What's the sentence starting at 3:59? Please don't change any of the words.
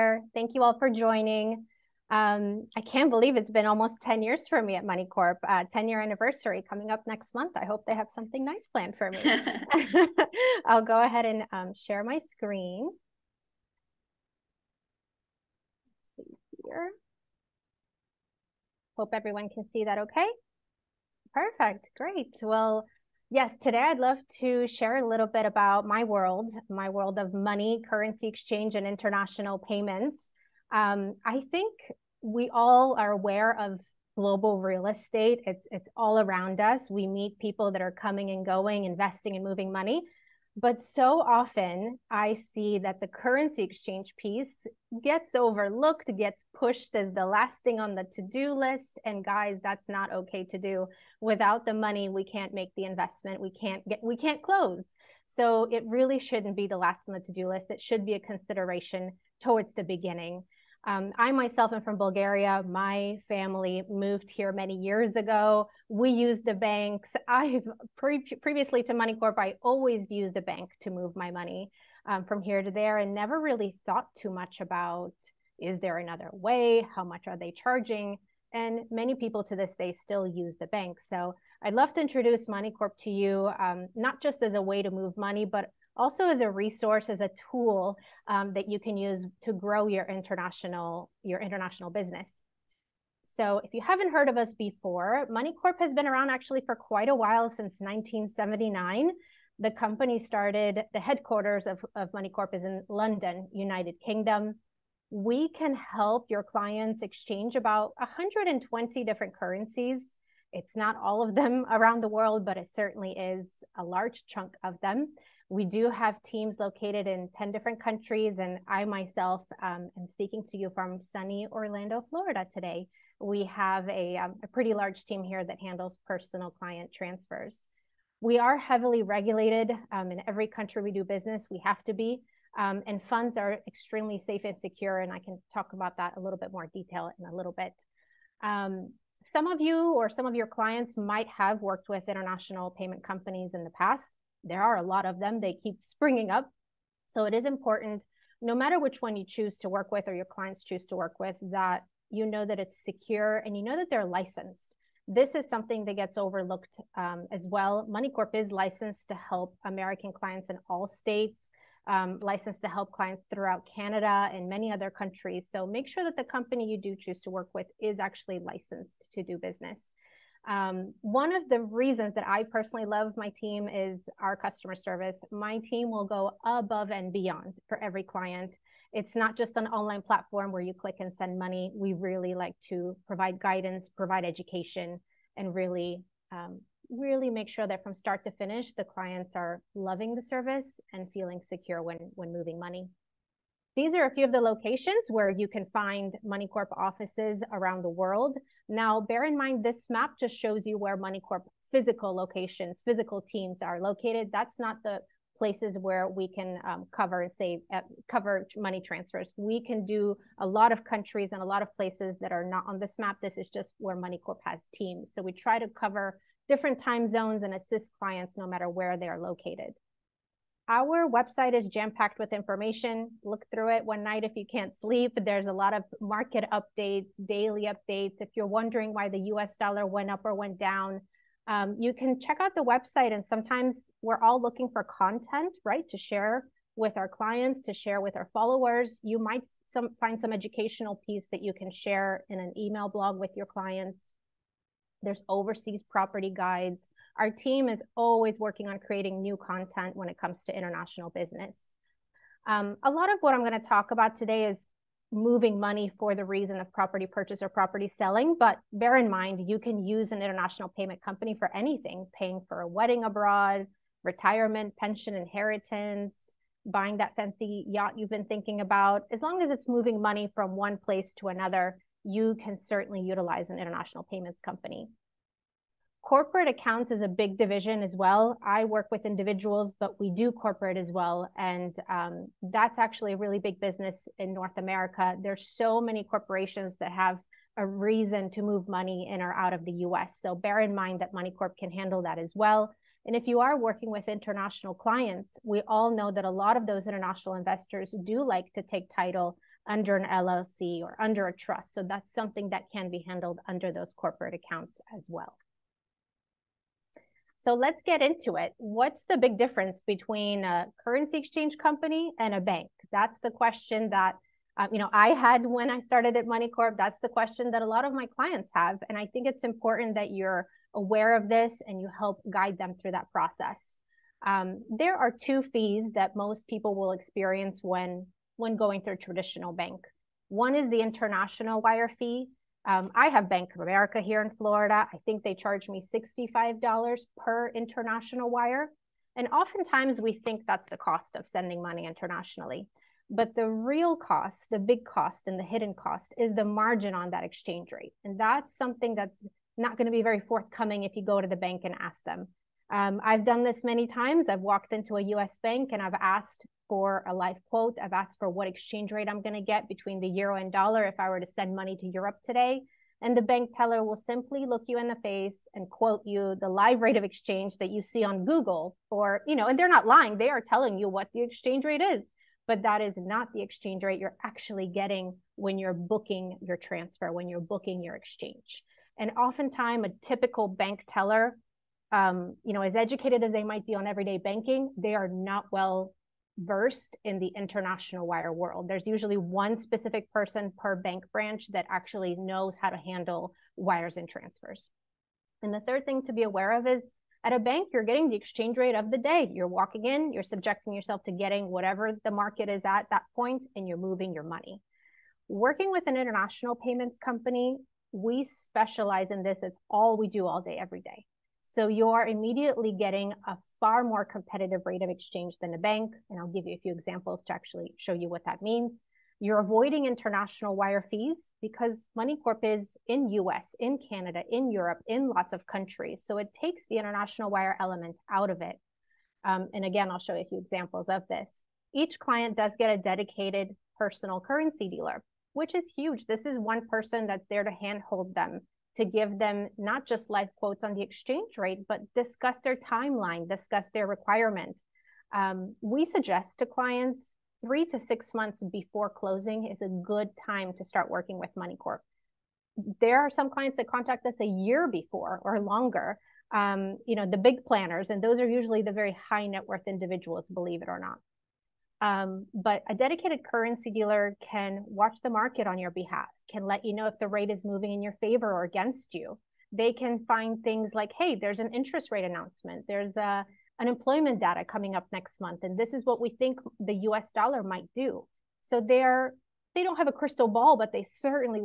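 You might some, find some educational piece that you can share in an email blog with your clients there's overseas property guides.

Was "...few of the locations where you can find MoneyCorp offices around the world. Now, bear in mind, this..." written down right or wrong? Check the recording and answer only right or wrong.
right.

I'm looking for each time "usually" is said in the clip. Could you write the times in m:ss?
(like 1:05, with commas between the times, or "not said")
6:28, 7:38.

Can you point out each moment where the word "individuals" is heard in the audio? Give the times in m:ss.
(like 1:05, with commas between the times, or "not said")
4:39, 7:39.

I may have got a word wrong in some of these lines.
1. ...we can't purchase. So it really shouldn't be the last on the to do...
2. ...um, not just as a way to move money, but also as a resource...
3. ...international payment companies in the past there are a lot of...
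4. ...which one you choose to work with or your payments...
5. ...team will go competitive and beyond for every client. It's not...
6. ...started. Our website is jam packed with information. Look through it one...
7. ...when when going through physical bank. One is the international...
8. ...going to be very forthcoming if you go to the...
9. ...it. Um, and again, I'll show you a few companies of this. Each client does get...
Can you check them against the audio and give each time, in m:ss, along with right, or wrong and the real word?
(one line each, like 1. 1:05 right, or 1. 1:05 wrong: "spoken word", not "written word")
1. 0:54 wrong: "close", not "purchase"
2. 1:23 right
3. 2:22 right
4. 2:28 wrong: "clients", not "payments"
5. 2:55 wrong: "above", not "competitive"
6. 3:39 wrong: "located", not "started"
7. 5:27 wrong: "traditional", not "physical"
8. 5:49 right
9. 7:08 wrong: "examples", not "companies".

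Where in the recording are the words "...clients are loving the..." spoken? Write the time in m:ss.
3:08.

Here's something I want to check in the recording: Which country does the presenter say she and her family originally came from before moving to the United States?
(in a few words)
Bulgaria.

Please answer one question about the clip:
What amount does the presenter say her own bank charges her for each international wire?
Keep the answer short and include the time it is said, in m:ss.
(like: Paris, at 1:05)
$65, at 5:35.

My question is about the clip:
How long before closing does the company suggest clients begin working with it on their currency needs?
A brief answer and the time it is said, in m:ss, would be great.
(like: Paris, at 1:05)
3 to 6 months, at 7:27.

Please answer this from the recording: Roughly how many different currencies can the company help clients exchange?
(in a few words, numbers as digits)
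120.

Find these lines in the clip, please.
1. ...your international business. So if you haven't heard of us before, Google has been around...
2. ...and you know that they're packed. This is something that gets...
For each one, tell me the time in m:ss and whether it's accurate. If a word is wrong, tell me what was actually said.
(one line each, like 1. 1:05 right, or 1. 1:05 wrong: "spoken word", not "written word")
1. 1:31 wrong: "MoneyCorp", not "Google"
2. 2:33 wrong: "licensed", not "packed".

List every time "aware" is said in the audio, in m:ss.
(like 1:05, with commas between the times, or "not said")
0:33, 5:20, 6:36.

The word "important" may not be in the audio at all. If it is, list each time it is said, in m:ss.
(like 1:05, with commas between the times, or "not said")
2:27, 5:19.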